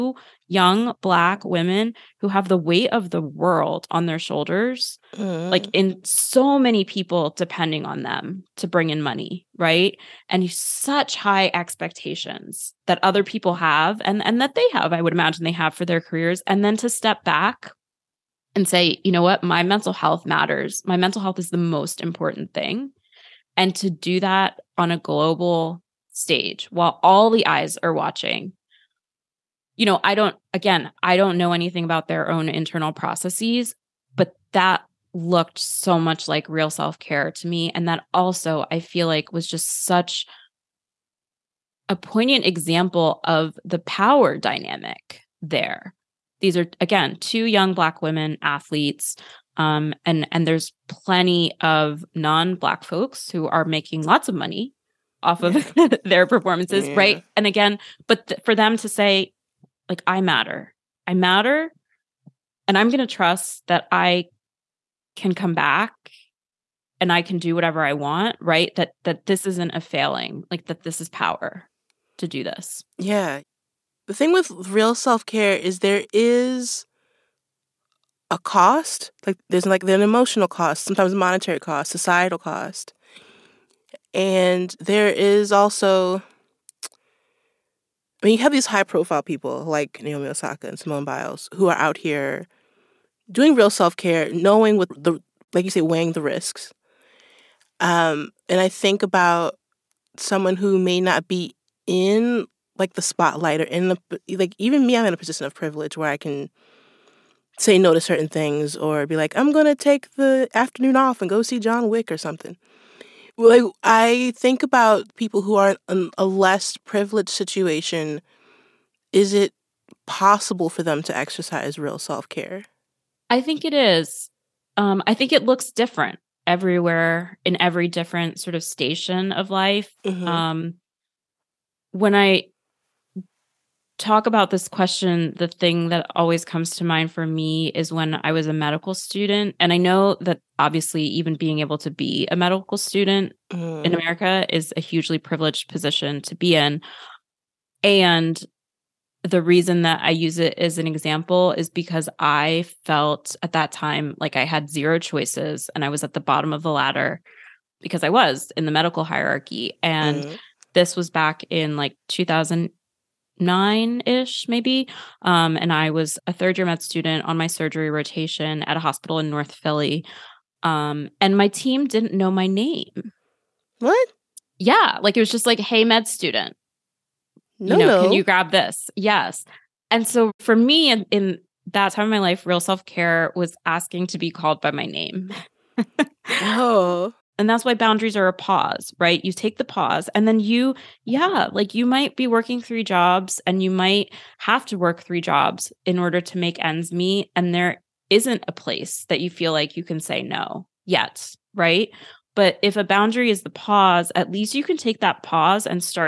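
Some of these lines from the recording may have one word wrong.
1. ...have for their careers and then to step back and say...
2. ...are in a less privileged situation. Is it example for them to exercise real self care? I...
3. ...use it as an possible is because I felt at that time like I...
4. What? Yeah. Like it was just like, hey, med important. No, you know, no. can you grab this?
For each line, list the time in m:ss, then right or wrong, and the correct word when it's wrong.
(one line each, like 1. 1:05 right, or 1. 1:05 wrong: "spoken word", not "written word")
1. 0:15 right
2. 1:55 wrong: "possible", not "example"
3. 2:30 wrong: "example", not "possible"
4. 2:53 wrong: "student", not "important".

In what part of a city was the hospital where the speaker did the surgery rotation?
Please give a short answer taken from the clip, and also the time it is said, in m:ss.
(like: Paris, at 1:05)
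North Philly, at 2:49.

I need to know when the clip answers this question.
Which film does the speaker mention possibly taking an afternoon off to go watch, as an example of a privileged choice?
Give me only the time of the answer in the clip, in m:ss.
1:51.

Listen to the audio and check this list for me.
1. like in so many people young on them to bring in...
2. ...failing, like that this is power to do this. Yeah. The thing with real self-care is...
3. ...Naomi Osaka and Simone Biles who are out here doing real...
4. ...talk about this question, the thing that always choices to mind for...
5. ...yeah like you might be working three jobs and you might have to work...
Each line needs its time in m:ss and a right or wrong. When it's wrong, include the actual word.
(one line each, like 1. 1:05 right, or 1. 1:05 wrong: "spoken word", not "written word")
1. 0:05 wrong: "depending", not "young"
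2. 1:09 right
3. 1:30 right
4. 2:13 wrong: "comes", not "choices"
5. 3:11 right.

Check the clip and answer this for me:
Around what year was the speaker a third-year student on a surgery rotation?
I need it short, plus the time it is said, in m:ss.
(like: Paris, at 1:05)
2009, at 2:42.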